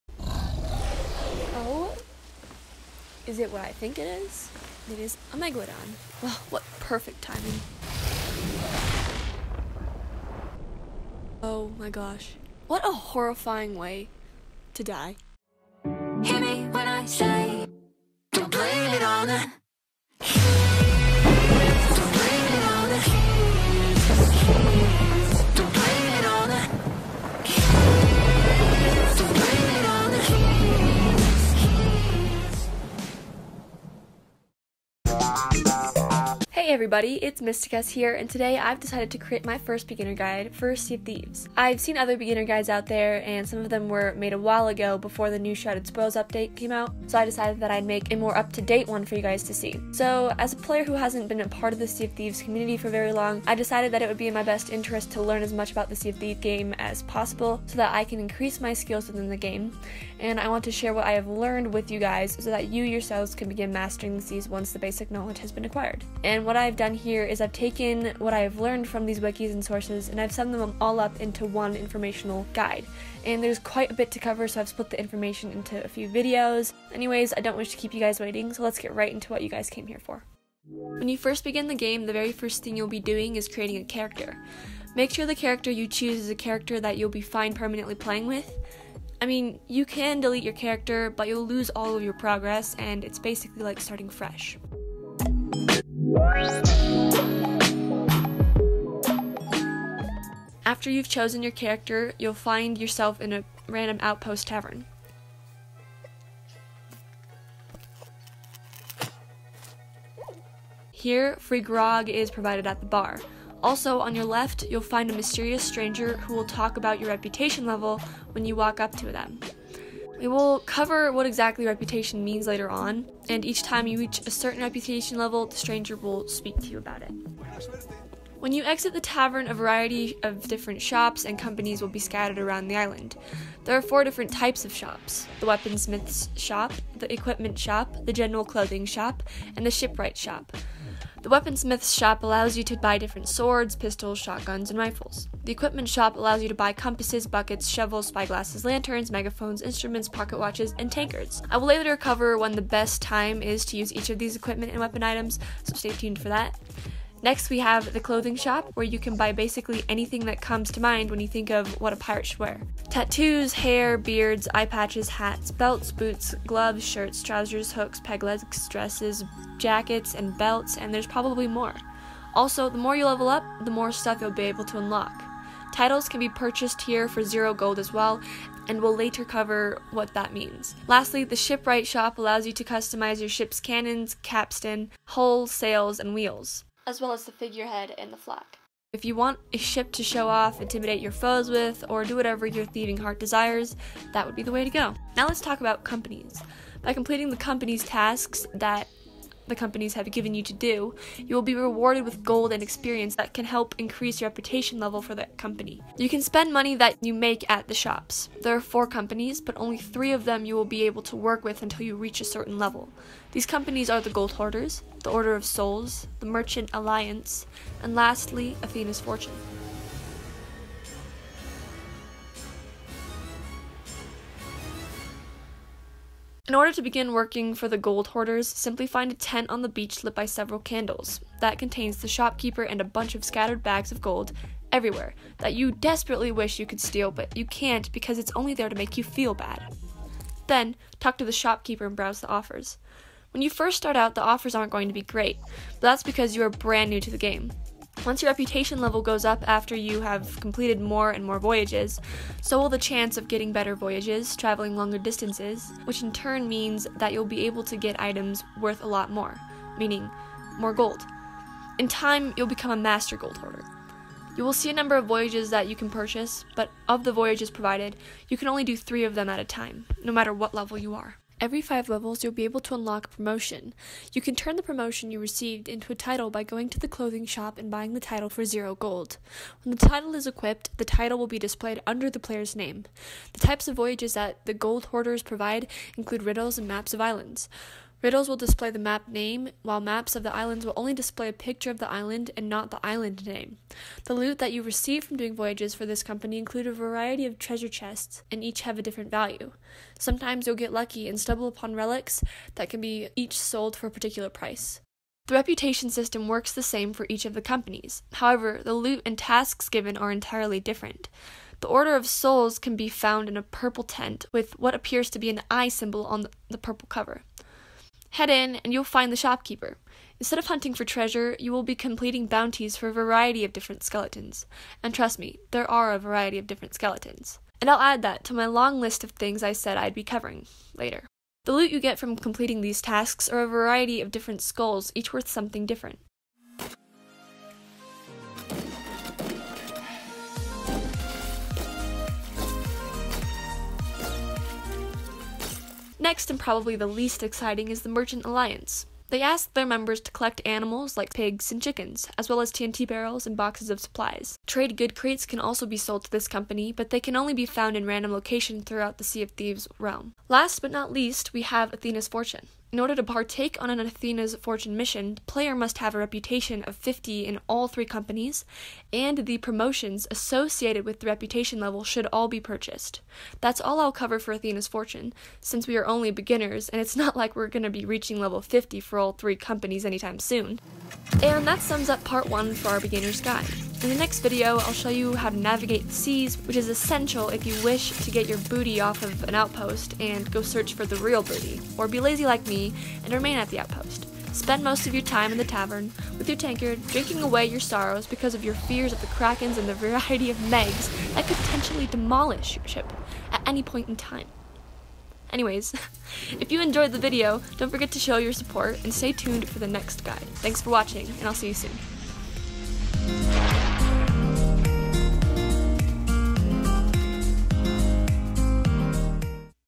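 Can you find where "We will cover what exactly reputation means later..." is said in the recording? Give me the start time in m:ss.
2:00.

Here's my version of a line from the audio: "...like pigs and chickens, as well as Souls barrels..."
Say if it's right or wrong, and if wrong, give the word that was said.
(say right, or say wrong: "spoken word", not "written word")
wrong: "TNT", not "Souls".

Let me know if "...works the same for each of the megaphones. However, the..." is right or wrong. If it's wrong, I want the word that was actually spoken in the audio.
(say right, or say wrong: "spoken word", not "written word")
wrong: "companies", not "megaphones".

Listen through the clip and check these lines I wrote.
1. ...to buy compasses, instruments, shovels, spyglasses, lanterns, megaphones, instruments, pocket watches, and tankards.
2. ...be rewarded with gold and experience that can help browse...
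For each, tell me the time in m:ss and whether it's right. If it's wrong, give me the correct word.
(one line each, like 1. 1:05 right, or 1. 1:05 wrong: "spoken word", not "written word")
1. 2:26 wrong: "buckets", not "instruments"
2. 3:21 wrong: "increase", not "browse".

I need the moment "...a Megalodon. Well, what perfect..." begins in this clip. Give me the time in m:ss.
0:05.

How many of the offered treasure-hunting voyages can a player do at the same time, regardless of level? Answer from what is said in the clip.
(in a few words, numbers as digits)
3.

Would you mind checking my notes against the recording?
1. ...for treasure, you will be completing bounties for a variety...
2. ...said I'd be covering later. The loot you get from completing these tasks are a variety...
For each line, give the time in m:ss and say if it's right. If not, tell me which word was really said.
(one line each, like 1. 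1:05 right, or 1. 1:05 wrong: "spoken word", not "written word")
1. 5:20 right
2. 5:29 right.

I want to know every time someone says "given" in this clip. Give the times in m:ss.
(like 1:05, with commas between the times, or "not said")
3:20, 5:09.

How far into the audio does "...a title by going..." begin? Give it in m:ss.
4:35.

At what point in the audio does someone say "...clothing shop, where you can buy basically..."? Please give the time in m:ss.
2:37.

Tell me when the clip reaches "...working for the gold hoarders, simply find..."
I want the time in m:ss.
3:47.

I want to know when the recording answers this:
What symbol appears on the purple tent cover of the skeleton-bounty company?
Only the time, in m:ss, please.
5:15.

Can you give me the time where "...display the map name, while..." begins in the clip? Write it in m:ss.
4:48.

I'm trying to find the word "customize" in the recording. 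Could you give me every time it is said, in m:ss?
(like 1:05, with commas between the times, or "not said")
3:02.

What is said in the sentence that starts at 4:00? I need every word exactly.
Then, talk to the shopkeeper and browse the offers.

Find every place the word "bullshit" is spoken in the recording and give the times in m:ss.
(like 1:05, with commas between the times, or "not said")
not said.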